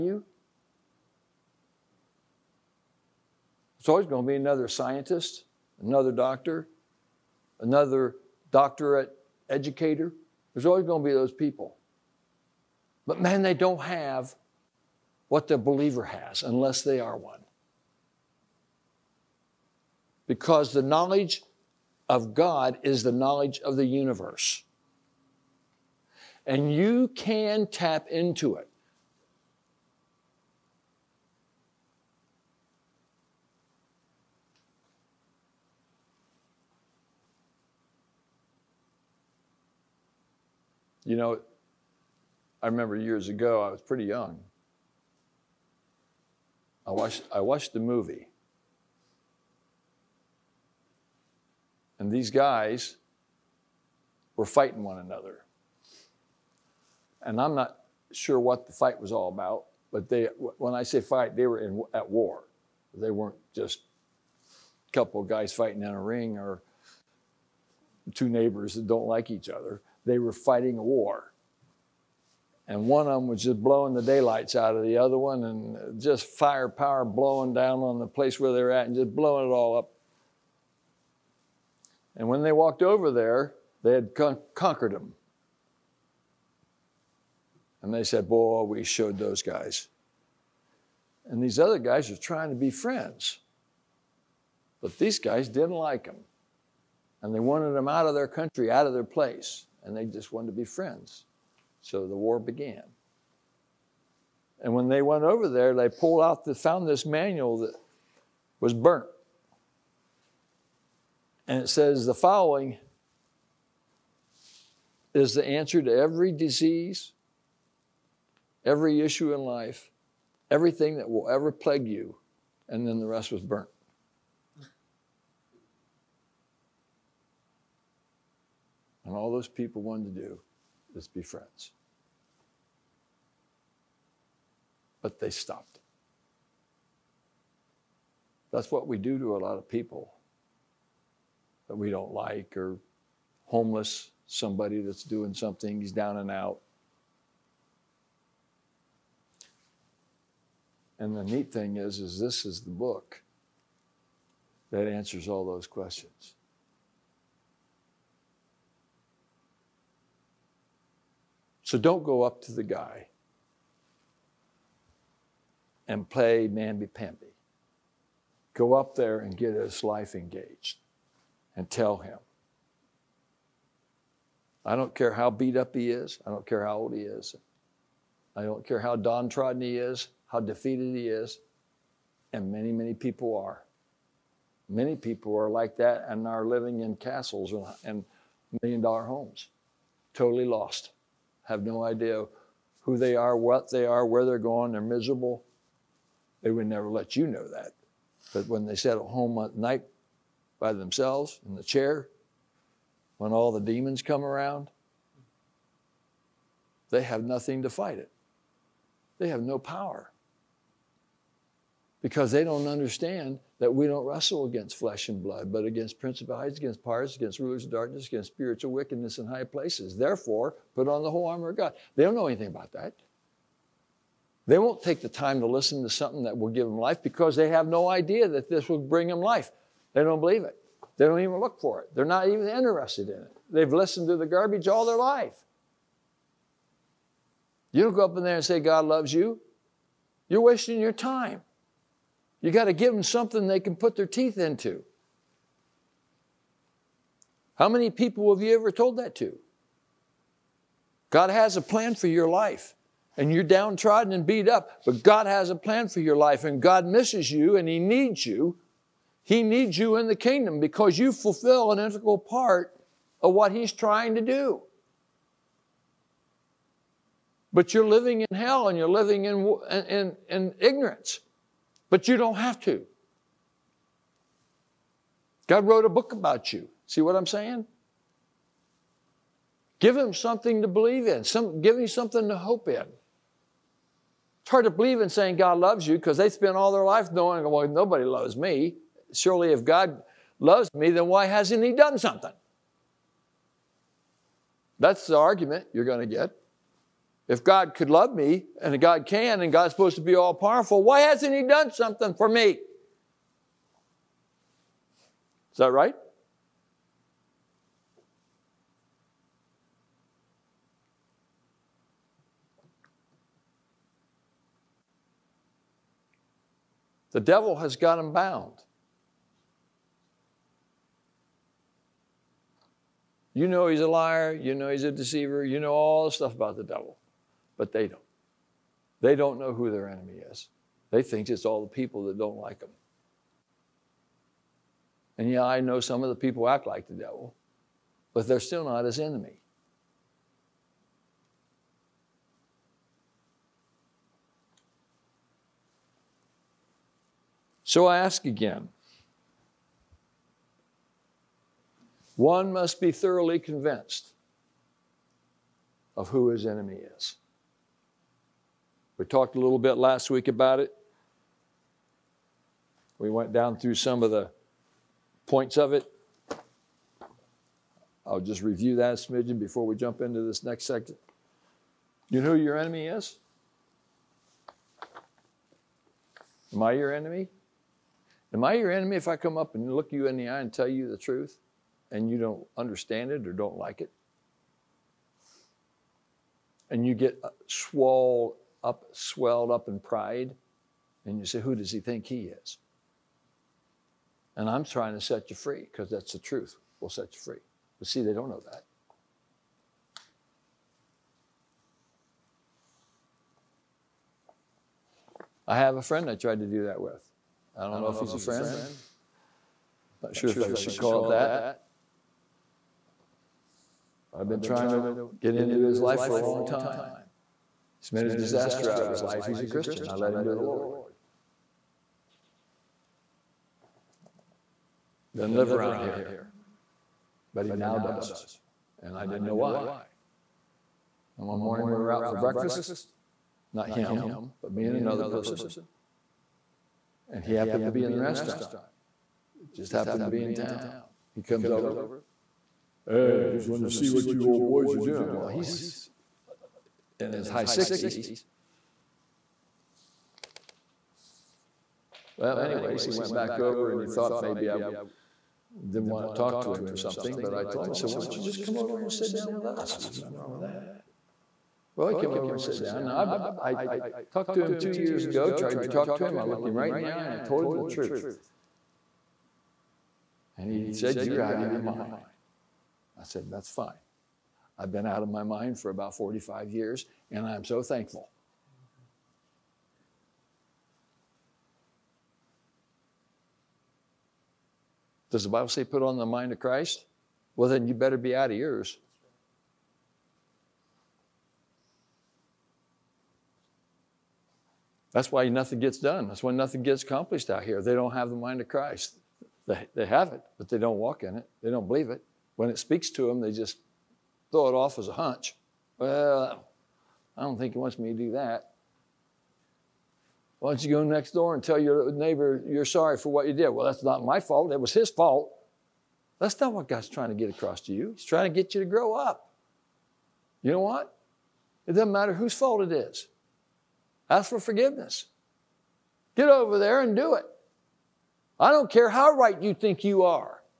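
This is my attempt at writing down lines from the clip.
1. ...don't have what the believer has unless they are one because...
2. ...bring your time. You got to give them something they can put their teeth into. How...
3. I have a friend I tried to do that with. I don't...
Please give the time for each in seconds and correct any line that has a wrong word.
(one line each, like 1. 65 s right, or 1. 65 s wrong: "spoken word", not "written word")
1. 13 s right
2. 240 s wrong: "wasting", not "bring"
3. 405 s right.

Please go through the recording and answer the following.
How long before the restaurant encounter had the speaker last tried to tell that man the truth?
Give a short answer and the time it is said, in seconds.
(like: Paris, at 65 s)
2 years, at 464 s.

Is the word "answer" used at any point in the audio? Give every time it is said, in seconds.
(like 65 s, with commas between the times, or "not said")
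115 s, 154 s.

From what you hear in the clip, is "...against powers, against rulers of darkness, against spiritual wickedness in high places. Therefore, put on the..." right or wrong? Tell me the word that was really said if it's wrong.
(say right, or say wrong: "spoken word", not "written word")
right.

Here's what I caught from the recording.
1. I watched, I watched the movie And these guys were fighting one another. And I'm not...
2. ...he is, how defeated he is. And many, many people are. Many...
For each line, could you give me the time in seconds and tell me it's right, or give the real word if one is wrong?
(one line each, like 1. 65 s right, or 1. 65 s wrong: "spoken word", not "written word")
1. 46 s right
2. 179 s right.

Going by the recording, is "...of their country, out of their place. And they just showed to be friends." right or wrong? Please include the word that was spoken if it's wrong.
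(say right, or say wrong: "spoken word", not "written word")
wrong: "wanted", not "showed".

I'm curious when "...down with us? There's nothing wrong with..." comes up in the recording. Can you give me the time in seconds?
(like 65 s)
459 s.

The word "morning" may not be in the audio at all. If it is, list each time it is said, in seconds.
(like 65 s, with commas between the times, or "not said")
431 s.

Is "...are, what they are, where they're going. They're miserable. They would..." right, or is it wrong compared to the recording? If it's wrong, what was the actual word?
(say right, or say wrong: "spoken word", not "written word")
right.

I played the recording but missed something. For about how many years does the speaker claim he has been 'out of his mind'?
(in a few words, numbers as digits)
45.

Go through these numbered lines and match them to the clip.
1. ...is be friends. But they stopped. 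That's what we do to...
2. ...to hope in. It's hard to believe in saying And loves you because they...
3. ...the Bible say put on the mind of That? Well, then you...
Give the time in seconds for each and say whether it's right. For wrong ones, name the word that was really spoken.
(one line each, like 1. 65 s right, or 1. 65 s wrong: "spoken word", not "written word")
1. 130 s right
2. 282 s wrong: "God", not "And"
3. 485 s wrong: "Christ", not "That".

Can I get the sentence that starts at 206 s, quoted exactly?
They have nothing to fight it.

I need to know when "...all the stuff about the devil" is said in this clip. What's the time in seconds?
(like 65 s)
325 s.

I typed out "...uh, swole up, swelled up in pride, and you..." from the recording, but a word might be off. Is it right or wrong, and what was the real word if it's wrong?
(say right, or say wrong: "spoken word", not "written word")
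right.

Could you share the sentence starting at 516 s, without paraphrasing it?
That's not what God's trying to get across to you.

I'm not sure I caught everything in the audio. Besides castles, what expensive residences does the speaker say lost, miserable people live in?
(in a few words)
million dollar homes.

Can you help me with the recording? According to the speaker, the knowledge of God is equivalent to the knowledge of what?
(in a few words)
the universe.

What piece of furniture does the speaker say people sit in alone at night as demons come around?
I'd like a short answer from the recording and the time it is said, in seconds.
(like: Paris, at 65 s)
the chair, at 201 s.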